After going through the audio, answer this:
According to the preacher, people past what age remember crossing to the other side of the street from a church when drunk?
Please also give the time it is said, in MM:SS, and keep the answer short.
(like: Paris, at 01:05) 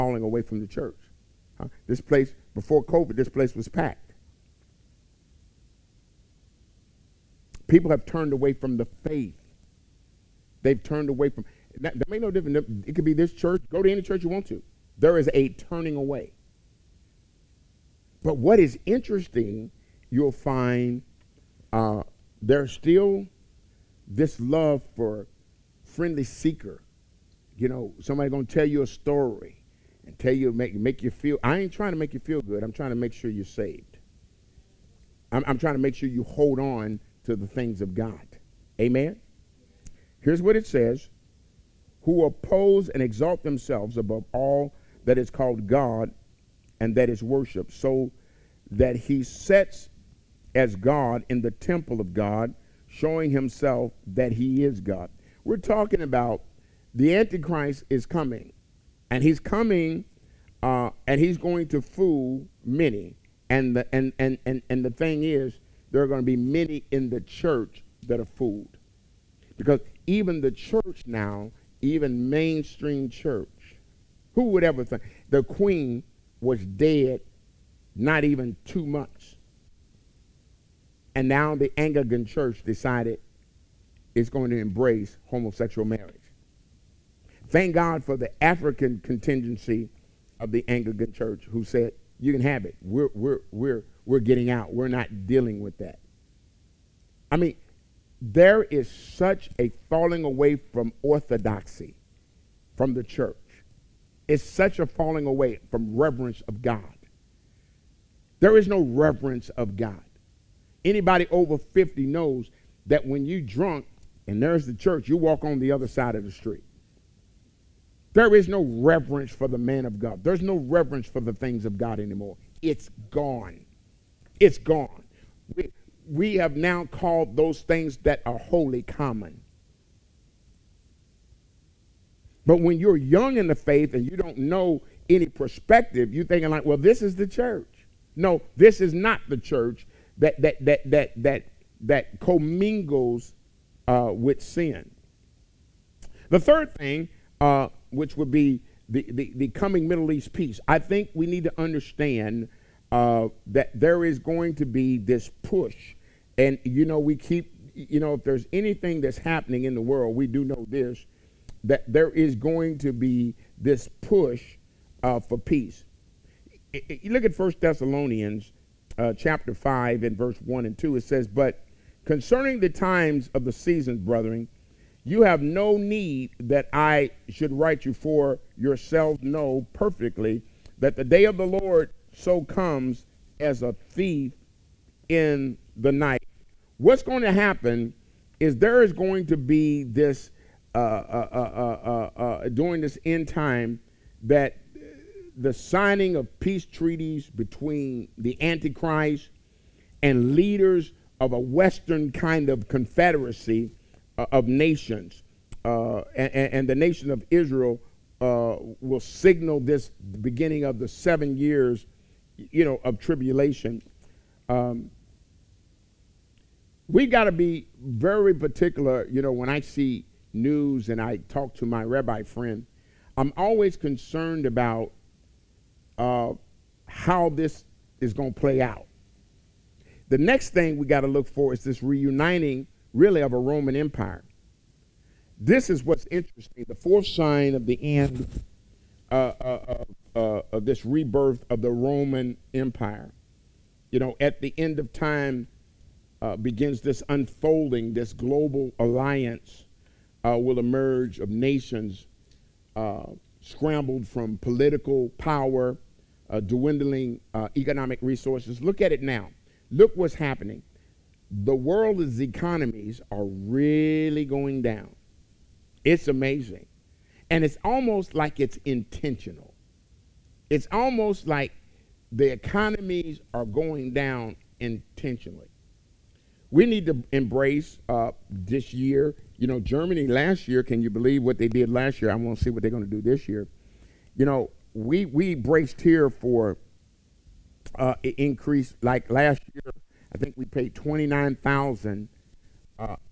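50, at 01:51.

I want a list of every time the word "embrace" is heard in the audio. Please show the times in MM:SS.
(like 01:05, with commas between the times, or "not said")
01:24, 04:37.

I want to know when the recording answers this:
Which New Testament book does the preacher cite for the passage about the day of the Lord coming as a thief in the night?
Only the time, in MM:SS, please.
02:47.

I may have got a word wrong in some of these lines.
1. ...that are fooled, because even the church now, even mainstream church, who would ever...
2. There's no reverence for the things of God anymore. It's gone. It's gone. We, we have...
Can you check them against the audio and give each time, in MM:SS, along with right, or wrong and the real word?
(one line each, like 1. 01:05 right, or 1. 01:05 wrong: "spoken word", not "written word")
1. 01:08 right
2. 02:00 right.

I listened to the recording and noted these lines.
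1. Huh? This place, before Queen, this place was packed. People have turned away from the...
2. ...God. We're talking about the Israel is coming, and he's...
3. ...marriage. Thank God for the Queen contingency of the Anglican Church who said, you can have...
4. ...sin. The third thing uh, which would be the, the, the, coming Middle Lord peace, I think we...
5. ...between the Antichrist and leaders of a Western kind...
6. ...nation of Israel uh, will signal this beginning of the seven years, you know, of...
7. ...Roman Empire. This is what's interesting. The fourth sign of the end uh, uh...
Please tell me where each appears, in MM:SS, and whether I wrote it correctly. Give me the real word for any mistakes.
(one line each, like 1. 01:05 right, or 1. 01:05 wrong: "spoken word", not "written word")
1. 00:01 wrong: "COVID", not "Queen"
2. 00:54 wrong: "Antichrist", not "Israel"
3. 01:25 wrong: "African", not "Queen"
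4. 02:24 wrong: "East", not "Lord"
5. 03:17 right
6. 03:26 right
7. 03:53 right.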